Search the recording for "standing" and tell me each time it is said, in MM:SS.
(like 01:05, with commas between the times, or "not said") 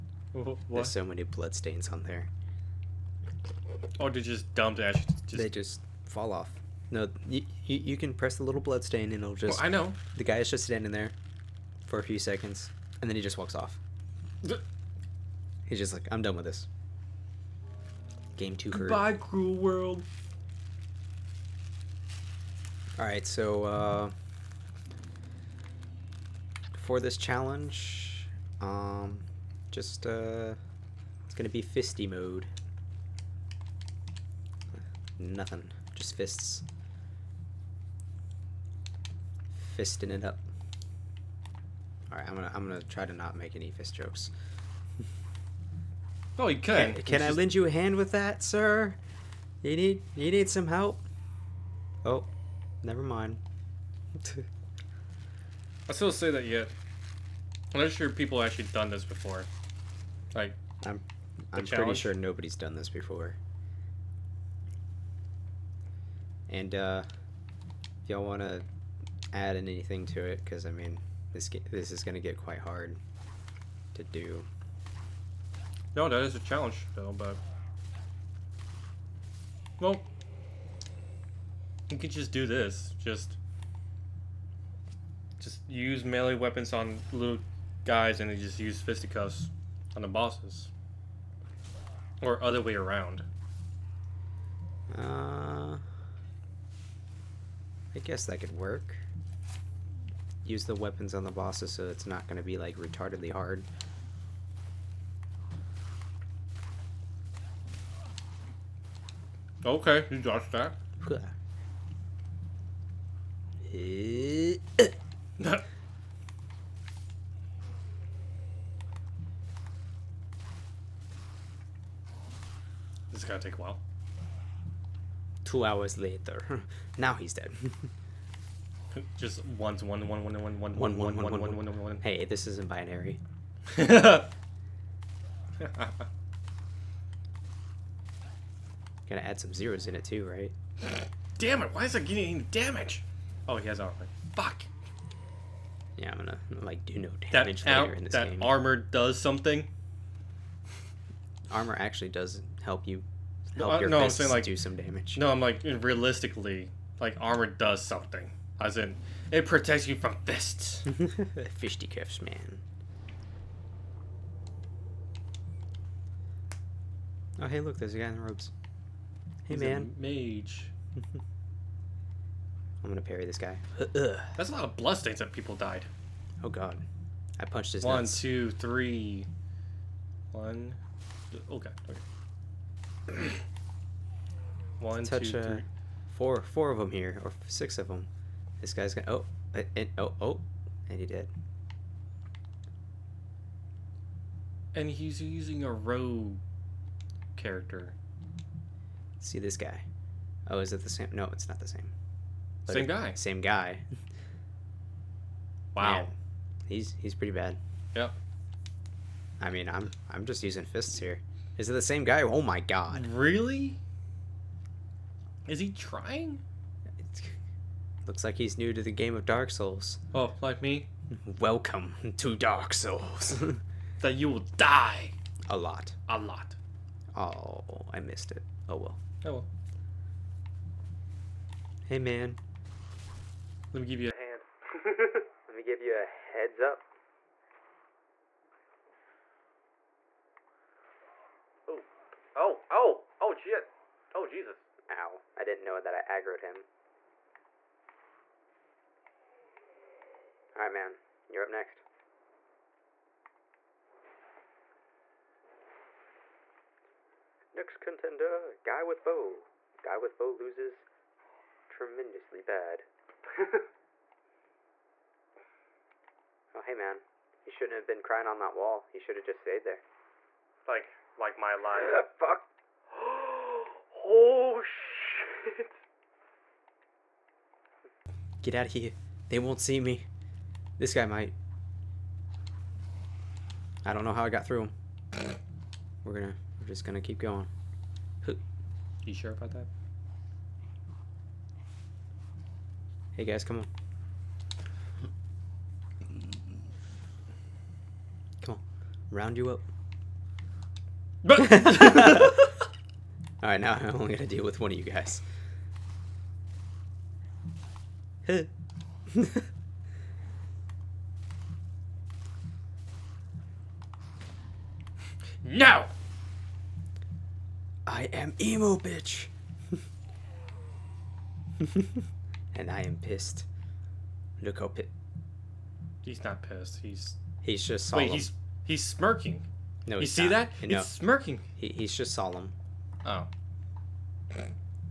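00:10.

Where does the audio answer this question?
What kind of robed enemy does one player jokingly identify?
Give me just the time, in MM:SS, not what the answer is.
02:49.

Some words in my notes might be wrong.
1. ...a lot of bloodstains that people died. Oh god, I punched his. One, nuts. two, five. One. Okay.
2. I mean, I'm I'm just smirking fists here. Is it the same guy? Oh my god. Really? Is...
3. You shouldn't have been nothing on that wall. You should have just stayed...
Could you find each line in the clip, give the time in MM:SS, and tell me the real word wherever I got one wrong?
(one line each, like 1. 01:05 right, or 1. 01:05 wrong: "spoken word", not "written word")
1. 02:54 wrong: "three", not "five"
2. 03:29 wrong: "using", not "smirking"
3. 04:27 wrong: "crying", not "nothing".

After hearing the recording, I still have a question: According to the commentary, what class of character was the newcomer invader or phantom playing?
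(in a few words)
rogue.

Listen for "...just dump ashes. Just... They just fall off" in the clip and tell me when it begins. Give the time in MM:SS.
00:04.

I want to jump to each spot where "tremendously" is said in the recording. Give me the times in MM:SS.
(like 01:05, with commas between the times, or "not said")
04:21.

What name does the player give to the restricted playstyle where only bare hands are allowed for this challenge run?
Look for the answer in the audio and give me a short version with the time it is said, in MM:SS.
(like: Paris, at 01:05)
fisty mode, at 00:31.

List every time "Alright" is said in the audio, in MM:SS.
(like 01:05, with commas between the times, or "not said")
00:42, 04:10, 05:01.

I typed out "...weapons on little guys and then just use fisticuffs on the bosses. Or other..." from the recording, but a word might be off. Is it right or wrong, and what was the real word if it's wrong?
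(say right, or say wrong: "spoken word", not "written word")
right.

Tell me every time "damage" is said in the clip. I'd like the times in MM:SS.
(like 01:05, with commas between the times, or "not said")
02:22, 02:27, 02:34.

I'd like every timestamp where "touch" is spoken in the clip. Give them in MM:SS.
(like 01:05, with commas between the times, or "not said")
03:05.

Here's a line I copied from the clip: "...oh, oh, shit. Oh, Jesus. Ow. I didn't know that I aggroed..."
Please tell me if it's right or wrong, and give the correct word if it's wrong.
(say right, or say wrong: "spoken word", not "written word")
right.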